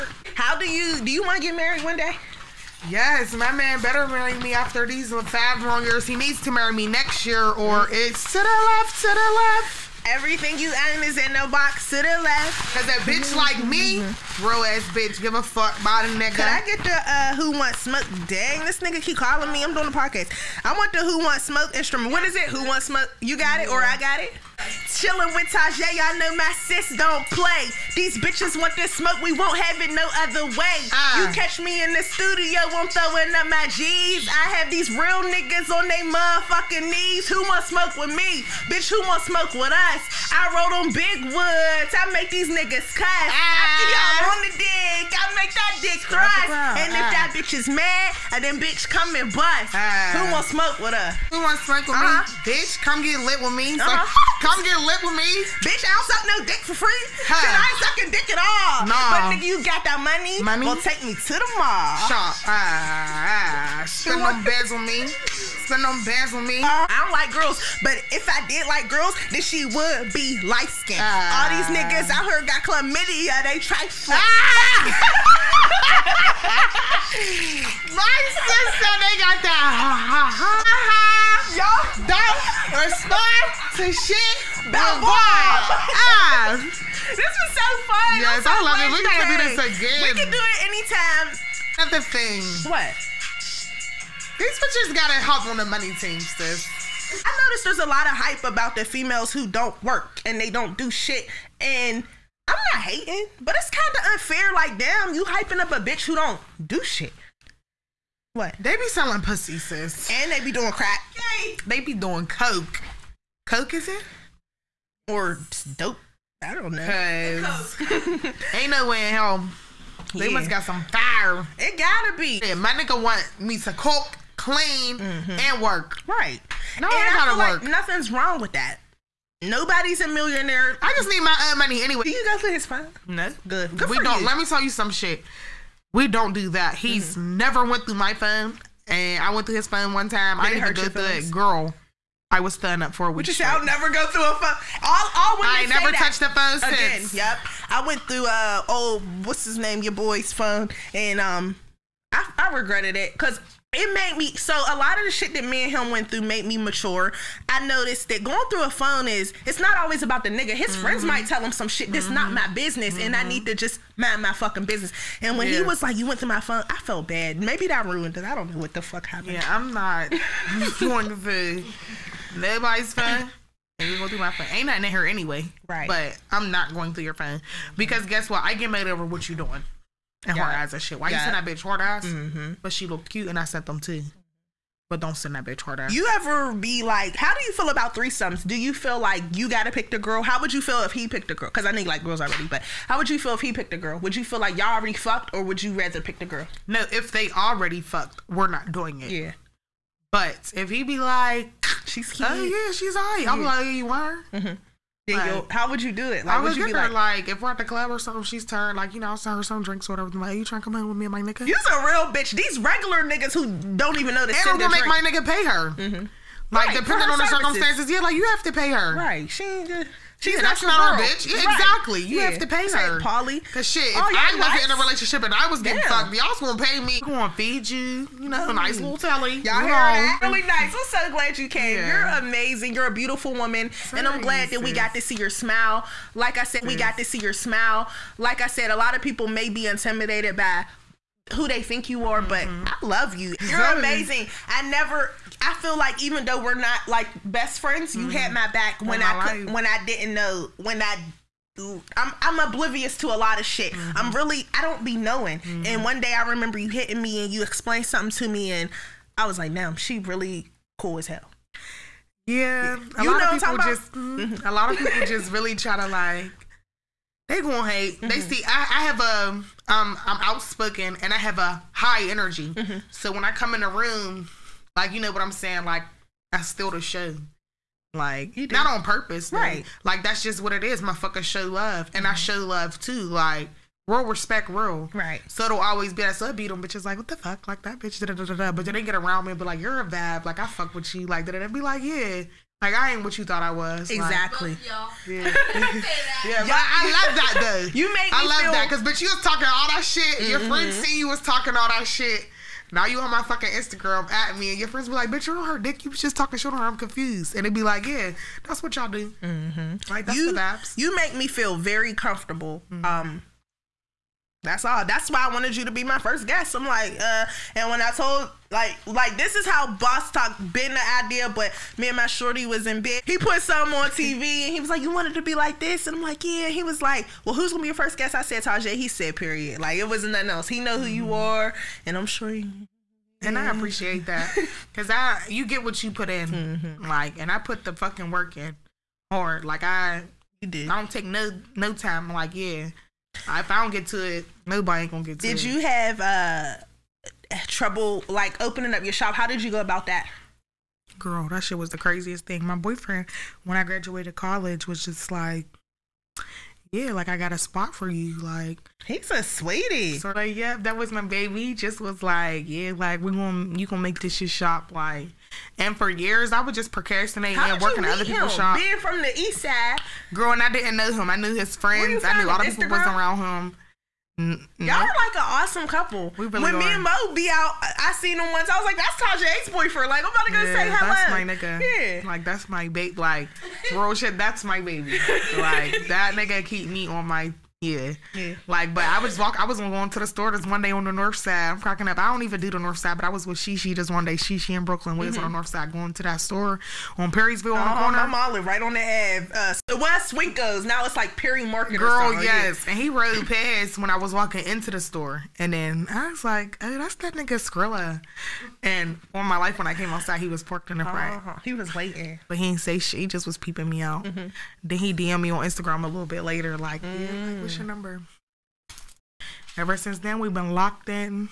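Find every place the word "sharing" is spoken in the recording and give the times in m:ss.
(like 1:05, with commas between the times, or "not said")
not said.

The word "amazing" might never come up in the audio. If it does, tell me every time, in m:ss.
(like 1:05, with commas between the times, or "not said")
3:52, 4:03.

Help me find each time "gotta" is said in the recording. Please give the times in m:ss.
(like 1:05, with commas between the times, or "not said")
2:01, 2:07, 3:09.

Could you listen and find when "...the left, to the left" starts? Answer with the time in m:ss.
0:08.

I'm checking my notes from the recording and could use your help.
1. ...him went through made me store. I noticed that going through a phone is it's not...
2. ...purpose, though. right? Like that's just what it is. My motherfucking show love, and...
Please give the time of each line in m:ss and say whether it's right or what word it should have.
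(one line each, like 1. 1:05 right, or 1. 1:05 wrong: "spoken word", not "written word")
1. 2:35 wrong: "mature", not "store"
2. 4:38 wrong: "fucking", not "motherfucking".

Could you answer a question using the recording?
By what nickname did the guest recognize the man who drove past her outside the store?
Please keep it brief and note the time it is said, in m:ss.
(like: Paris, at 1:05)
Skrilla, at 6:47.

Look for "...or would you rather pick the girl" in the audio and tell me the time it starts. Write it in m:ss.
3:15.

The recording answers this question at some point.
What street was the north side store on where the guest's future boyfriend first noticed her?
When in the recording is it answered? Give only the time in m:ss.
6:37.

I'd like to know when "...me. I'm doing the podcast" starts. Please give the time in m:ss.
0:19.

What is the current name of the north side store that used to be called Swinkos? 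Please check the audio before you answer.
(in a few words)
Perry Market.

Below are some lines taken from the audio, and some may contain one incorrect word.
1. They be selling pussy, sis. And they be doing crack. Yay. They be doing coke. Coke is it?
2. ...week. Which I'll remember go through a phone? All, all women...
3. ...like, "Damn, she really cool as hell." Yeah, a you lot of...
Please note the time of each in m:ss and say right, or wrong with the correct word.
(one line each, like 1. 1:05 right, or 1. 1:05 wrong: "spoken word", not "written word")
1. 1:48 right
2. 2:23 wrong: "never", not "remember"
3. 4:19 right.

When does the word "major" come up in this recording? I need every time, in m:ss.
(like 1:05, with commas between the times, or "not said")
not said.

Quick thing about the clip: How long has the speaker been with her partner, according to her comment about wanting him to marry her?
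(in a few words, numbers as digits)
5 years.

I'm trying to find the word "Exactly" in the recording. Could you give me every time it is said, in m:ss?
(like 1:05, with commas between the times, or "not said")
3:41, 4:54.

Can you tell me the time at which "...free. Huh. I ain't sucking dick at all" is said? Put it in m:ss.
0:56.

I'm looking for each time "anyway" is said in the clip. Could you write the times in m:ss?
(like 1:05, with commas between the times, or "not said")
2:11, 2:55.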